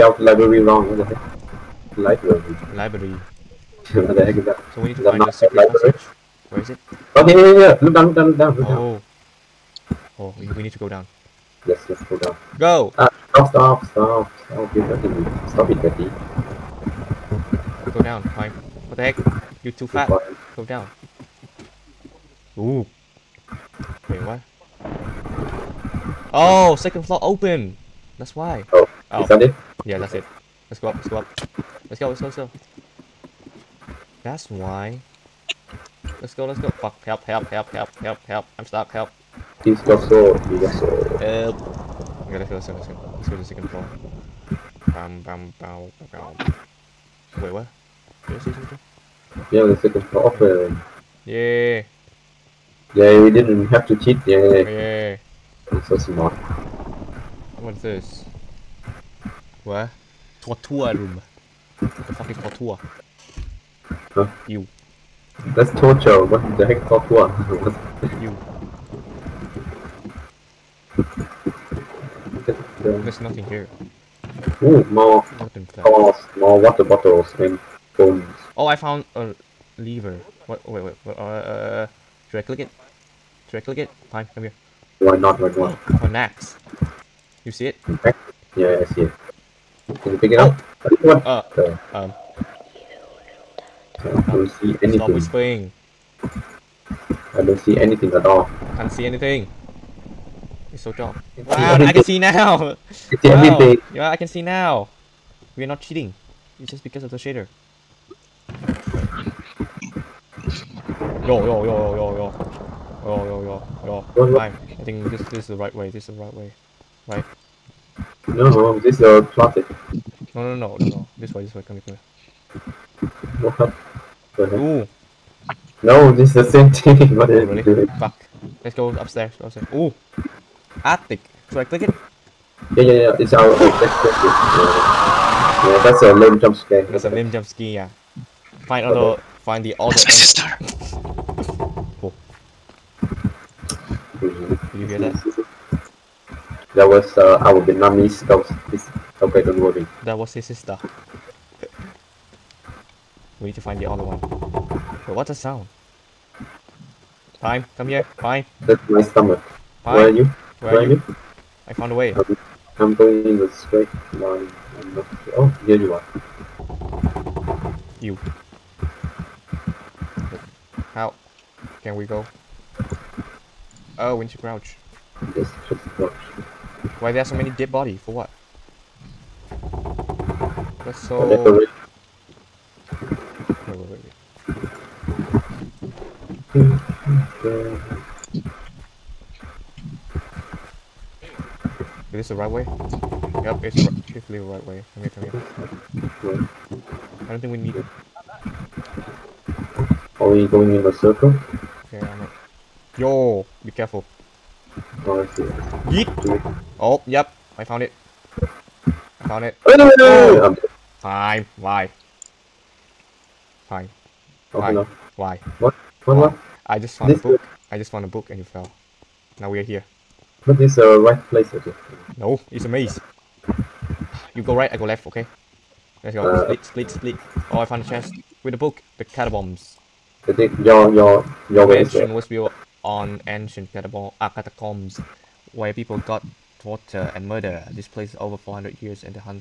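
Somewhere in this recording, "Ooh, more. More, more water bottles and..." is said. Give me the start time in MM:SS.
01:14.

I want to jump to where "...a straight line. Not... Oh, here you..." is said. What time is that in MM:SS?
02:43.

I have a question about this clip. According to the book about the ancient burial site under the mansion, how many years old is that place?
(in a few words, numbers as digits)
400 years.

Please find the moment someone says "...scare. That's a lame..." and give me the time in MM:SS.
02:16.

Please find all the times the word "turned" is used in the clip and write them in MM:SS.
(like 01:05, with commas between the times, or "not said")
not said.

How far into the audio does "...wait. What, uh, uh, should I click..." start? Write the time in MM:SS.
01:20.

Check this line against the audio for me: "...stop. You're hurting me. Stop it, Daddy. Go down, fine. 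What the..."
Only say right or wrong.
right.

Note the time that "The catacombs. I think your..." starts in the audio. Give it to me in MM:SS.
03:48.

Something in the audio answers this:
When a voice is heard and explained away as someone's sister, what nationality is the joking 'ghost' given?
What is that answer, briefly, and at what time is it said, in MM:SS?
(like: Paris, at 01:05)
Vietnamese, at 02:27.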